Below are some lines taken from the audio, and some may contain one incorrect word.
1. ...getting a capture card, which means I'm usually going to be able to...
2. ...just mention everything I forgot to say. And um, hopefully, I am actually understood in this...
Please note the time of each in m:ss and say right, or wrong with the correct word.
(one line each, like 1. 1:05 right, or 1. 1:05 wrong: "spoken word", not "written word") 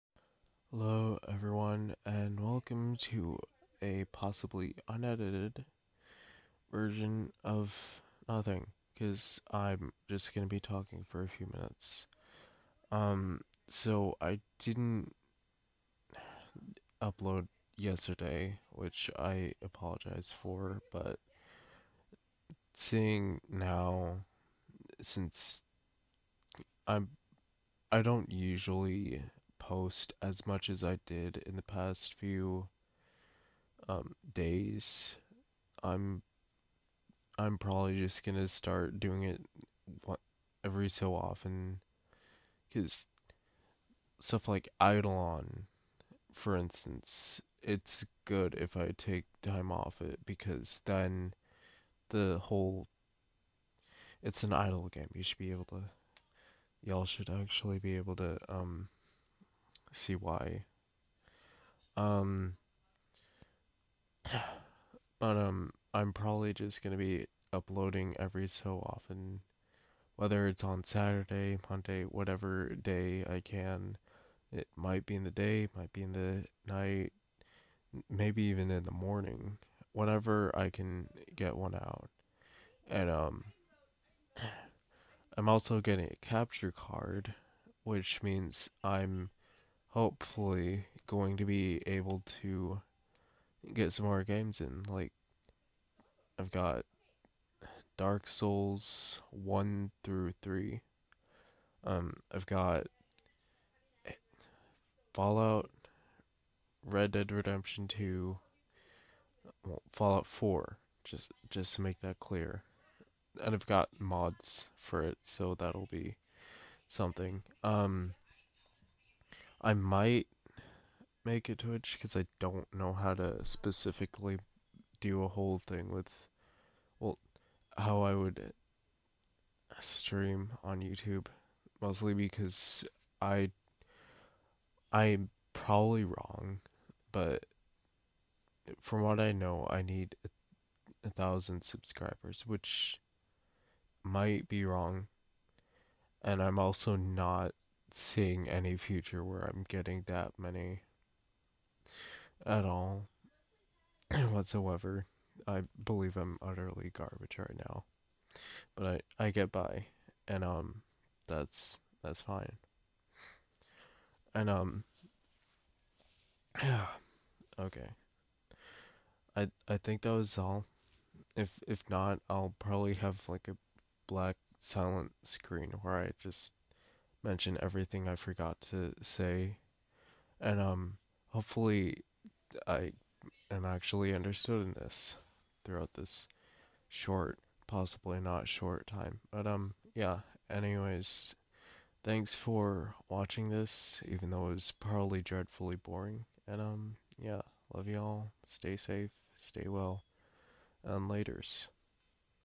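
1. 1:25 wrong: "hopefully", not "usually"
2. 2:56 right.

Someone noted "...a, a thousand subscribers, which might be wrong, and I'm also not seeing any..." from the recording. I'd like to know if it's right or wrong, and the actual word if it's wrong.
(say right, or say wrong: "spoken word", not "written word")
right.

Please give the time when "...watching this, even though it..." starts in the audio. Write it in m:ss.
3:13.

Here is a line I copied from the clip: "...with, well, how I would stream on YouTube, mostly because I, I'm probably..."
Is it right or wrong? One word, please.
right.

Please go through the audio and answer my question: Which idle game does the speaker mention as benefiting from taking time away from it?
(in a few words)
Idleon.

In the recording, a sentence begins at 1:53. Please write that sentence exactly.
And I've got mods for it, so that'll be something.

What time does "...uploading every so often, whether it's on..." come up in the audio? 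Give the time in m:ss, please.
1:07.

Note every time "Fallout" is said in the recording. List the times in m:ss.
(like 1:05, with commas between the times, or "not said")
1:45, 1:49.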